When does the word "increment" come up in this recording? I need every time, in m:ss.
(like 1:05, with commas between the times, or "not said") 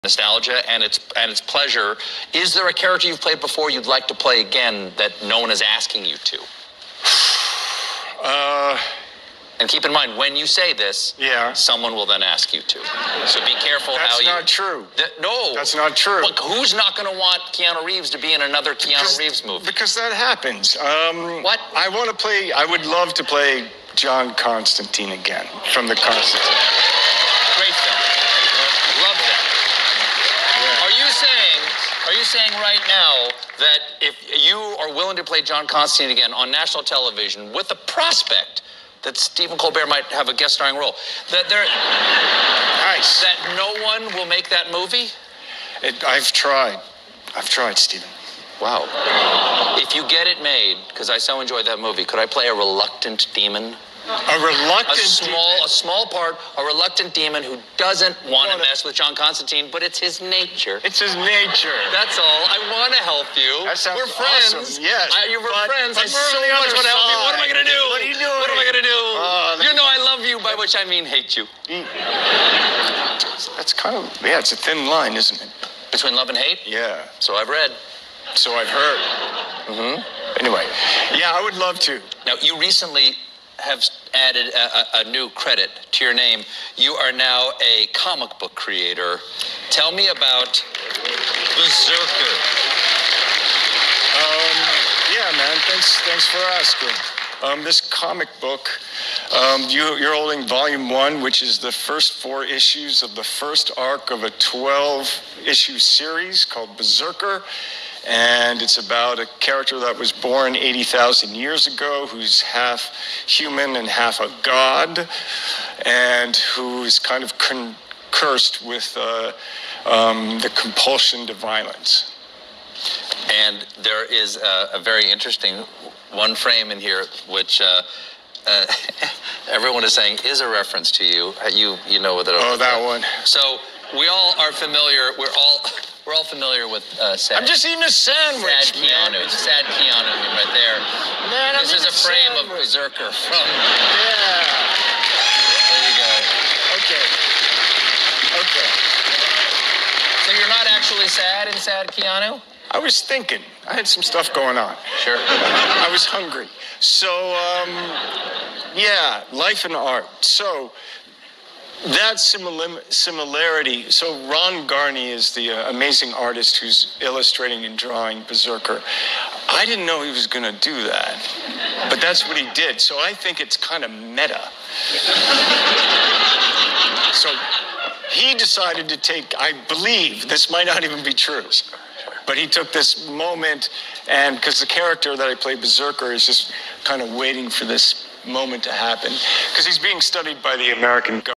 not said.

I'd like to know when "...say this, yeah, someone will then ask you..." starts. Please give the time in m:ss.
0:10.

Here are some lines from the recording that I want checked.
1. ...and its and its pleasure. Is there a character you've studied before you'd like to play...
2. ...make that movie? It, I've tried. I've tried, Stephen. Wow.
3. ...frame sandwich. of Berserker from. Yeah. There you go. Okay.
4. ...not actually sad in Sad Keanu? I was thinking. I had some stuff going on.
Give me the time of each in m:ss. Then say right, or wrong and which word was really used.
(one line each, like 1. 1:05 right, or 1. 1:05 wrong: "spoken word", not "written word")
1. 0:00 wrong: "played", not "studied"
2. 0:44 right
3. 2:21 right
4. 2:30 right.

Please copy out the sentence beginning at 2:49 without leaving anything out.
I didn't know he was going to do that, but that's what he did.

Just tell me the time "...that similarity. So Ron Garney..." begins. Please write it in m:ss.
2:41.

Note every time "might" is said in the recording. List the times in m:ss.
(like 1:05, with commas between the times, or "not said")
0:39, 3:00.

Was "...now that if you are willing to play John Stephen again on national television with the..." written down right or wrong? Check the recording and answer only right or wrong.
wrong.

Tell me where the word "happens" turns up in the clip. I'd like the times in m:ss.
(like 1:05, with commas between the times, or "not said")
0:20, 3:08.